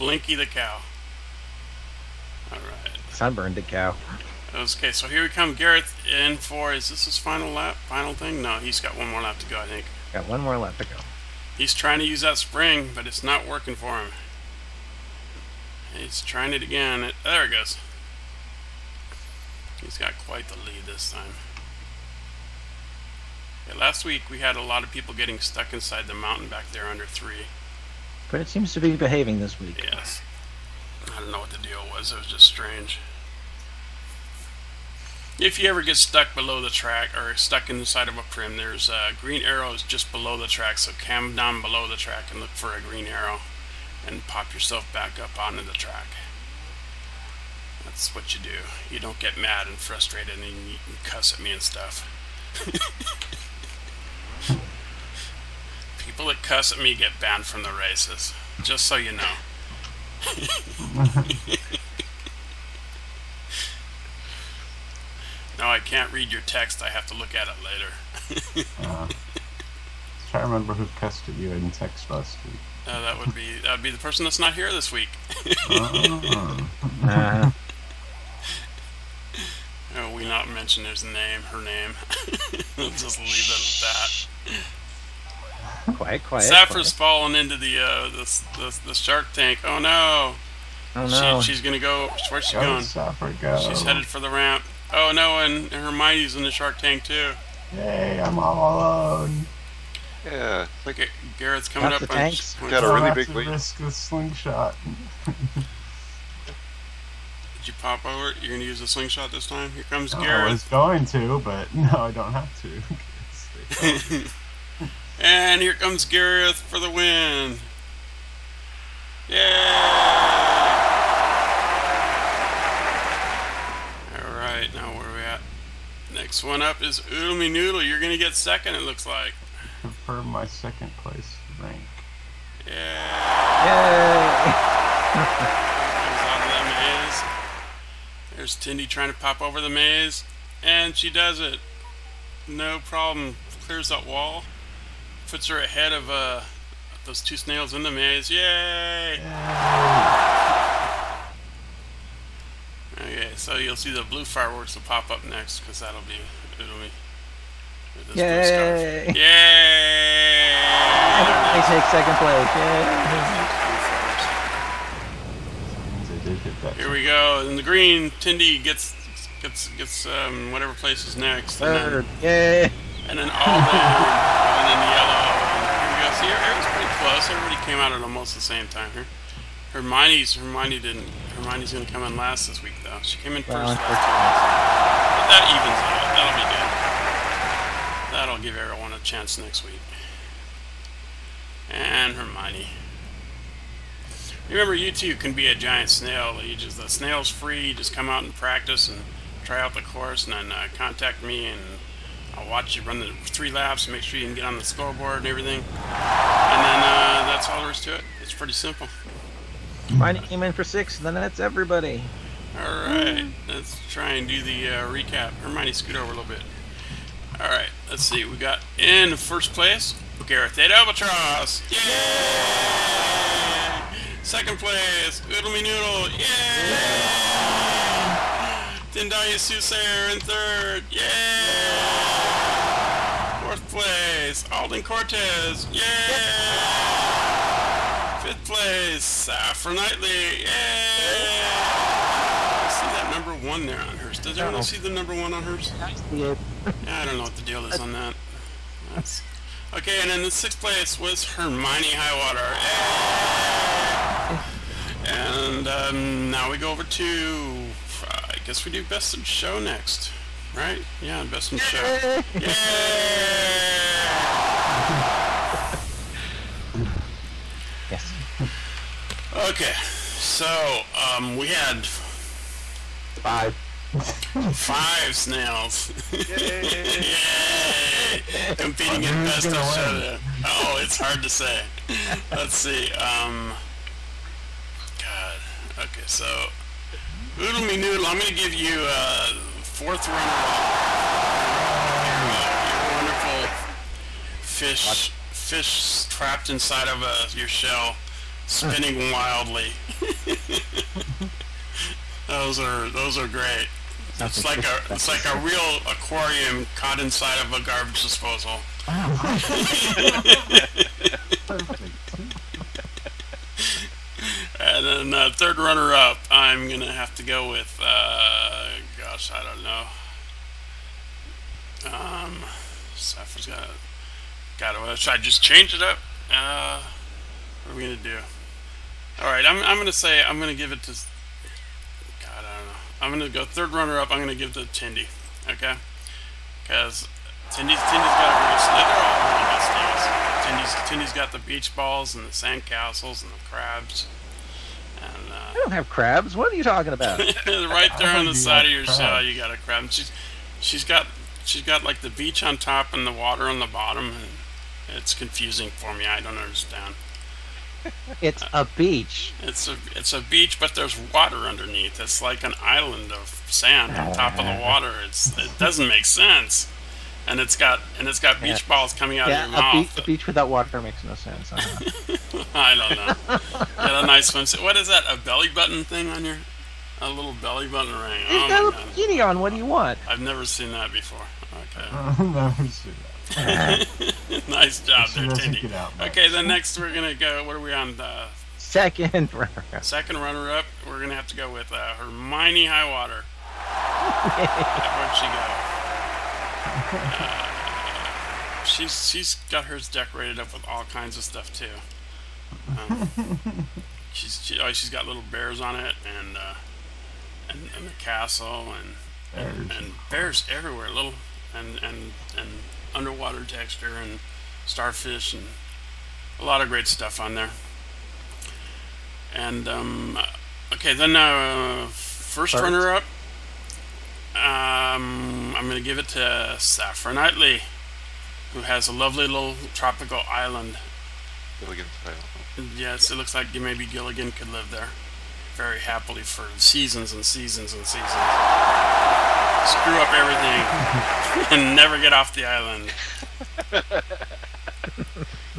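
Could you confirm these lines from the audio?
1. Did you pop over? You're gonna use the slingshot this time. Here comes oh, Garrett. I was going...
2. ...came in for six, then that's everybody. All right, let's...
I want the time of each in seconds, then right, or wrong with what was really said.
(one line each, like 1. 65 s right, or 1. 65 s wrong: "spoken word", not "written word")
1. 105 s right
2. 210 s right.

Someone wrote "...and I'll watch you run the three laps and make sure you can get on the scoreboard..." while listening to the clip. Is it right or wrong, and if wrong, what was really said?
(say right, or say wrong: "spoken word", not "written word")
right.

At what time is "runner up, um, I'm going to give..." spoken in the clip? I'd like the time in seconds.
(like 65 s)
422 s.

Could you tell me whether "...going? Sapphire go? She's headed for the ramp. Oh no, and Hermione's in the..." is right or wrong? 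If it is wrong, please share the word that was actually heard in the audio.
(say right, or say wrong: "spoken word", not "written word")
right.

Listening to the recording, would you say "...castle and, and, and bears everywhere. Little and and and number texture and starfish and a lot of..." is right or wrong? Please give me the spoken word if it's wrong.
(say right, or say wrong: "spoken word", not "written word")
wrong: "underwater", not "number".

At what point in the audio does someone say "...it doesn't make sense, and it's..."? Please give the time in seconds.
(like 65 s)
365 s.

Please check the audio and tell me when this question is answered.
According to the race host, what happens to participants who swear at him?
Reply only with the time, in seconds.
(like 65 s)
56 s.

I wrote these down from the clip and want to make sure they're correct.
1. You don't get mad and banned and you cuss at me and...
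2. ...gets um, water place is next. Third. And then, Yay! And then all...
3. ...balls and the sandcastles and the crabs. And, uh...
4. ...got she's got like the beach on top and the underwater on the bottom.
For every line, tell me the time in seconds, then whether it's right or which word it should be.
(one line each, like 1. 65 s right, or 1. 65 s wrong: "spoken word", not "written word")
1. 48 s wrong: "frustrated", not "banned"
2. 169 s wrong: "whatever", not "water"
3. 341 s right
4. 350 s wrong: "water", not "underwater".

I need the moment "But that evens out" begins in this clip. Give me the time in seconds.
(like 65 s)
183 s.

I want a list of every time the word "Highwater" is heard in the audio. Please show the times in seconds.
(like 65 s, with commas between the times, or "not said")
251 s, 392 s.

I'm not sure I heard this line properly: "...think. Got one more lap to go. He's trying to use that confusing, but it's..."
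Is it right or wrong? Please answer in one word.
wrong.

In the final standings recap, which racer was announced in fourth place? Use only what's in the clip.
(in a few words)
Alden Cortes.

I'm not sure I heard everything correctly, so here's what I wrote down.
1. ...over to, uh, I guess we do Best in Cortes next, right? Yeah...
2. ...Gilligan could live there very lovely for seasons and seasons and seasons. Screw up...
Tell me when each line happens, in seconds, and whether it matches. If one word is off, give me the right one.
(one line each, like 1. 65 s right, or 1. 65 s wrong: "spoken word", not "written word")
1. 256 s wrong: "Show", not "Cortes"
2. 433 s wrong: "happily", not "lovely".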